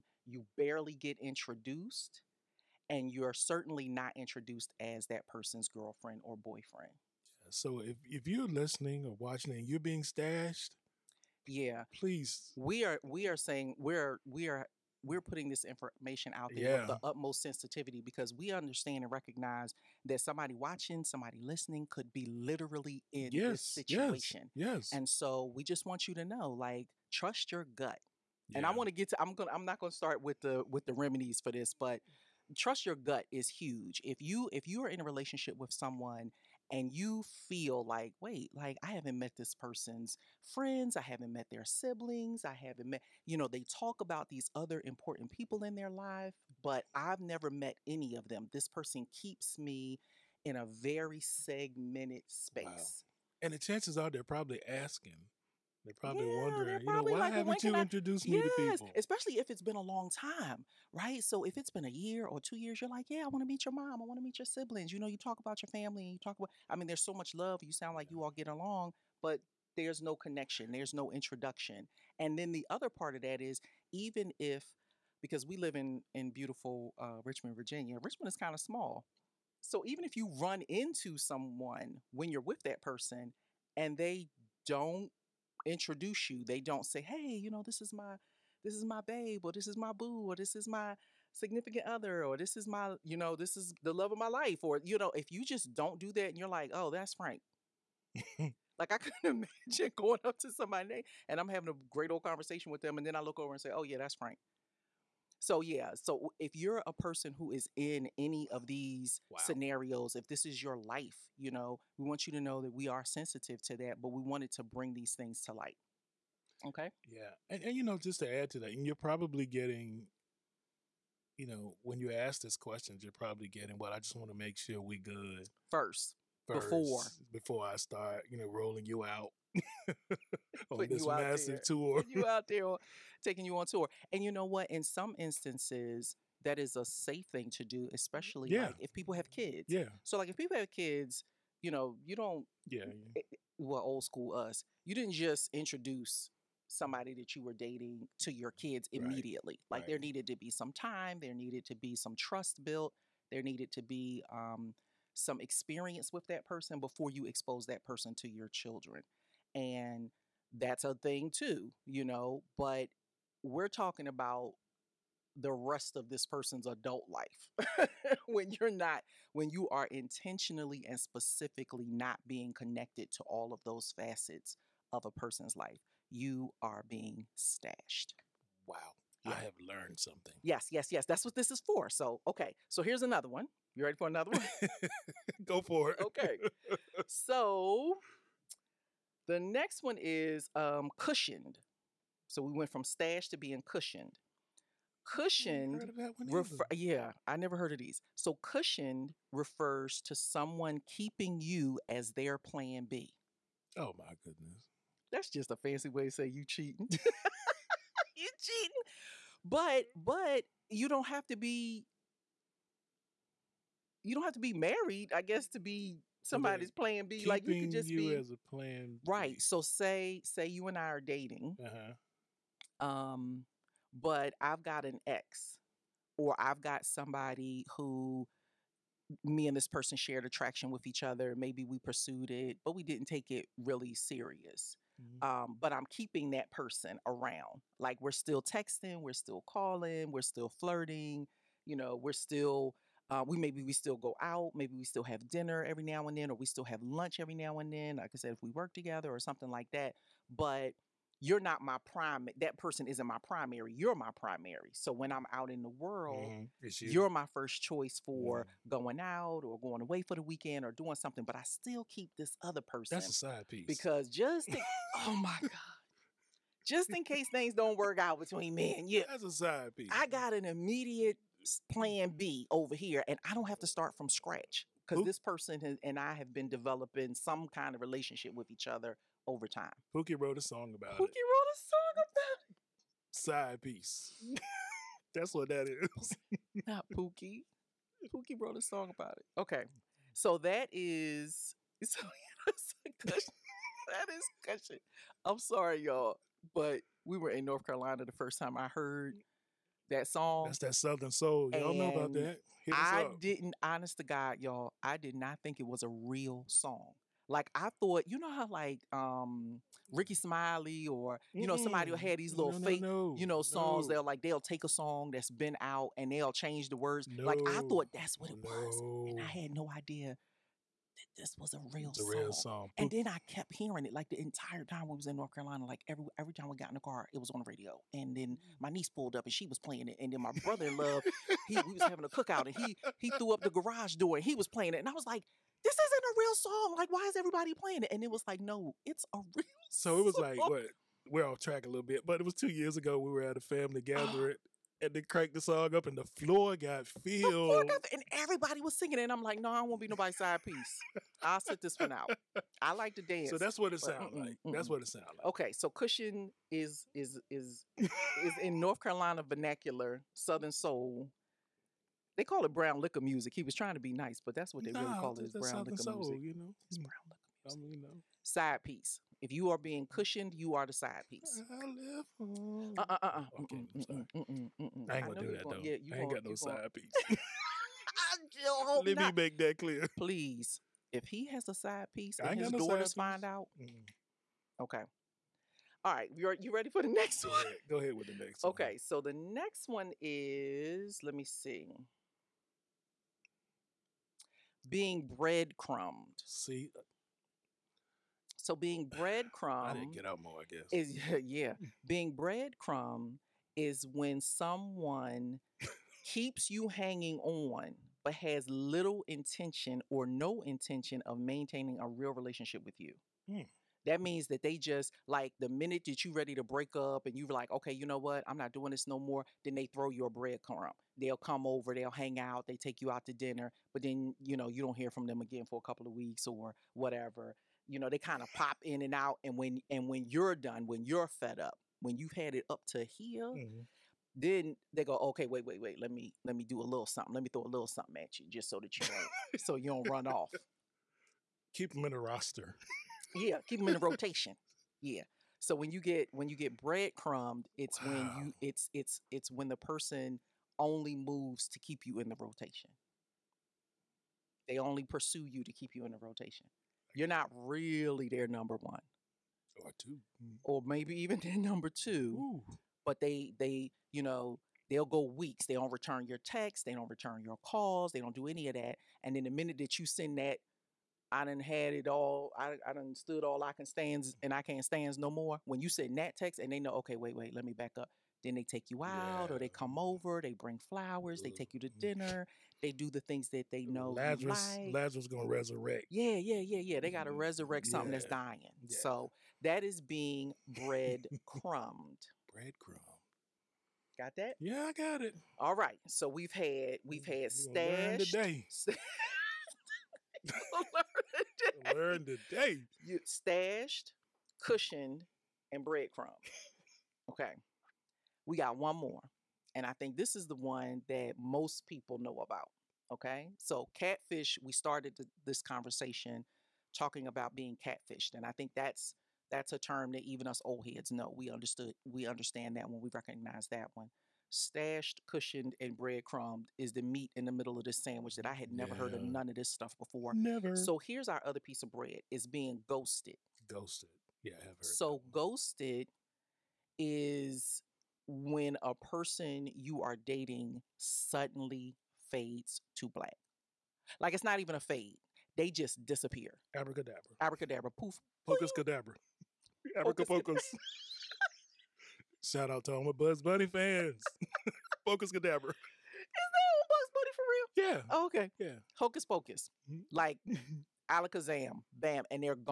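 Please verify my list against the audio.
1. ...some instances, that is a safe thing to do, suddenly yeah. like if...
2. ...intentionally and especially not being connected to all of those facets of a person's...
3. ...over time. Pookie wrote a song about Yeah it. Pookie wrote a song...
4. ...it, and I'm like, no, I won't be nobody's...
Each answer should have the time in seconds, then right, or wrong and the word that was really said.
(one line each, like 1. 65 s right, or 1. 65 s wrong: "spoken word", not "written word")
1. 134 s wrong: "especially", not "suddenly"
2. 169 s wrong: "specifically", not "especially"
3. 279 s wrong: "Pookie", not "Yeah"
4. 348 s right.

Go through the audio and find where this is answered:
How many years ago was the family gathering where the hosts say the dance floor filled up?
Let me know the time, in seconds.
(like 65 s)
342 s.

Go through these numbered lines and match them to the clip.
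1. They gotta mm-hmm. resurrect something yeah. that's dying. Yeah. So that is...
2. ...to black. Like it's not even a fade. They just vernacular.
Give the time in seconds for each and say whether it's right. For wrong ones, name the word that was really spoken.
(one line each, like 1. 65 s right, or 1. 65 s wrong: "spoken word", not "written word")
1. 486 s right
2. 542 s wrong: "disappear", not "vernacular".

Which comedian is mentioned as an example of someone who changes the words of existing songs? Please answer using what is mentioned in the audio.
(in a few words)
Rickey Smiley.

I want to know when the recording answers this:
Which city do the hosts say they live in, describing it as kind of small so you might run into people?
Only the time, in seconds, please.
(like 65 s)
77 s.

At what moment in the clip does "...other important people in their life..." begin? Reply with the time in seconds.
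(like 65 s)
44 s.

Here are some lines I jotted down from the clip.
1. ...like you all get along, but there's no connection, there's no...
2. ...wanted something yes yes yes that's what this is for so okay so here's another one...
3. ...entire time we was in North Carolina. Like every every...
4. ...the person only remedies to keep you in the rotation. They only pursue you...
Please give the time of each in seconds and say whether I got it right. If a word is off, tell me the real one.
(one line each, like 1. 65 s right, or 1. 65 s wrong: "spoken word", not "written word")
1. 67 s right
2. 179 s wrong: "learned", not "wanted"
3. 324 s right
4. 449 s wrong: "moves", not "remedies".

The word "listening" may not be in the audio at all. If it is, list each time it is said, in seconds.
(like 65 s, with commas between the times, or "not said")
8 s, 21 s.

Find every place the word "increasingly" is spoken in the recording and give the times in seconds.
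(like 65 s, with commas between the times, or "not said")
not said.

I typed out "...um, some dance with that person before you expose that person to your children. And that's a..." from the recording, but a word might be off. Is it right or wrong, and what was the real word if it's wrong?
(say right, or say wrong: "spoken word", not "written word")
wrong: "experience", not "dance".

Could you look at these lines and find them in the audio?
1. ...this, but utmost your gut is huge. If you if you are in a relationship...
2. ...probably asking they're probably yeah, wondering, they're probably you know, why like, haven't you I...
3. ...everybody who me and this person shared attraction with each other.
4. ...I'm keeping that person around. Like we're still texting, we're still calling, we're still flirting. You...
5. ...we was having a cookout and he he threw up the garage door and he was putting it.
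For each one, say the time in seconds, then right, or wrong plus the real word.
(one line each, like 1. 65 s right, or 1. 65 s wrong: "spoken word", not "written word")
1. 31 s wrong: "trust", not "utmost"
2. 54 s right
3. 226 s wrong: "somebody", not "everybody"
4. 235 s right
5. 331 s wrong: "playing", not "putting".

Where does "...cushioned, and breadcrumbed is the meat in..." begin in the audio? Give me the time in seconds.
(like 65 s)
525 s.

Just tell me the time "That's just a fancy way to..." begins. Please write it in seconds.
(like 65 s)
205 s.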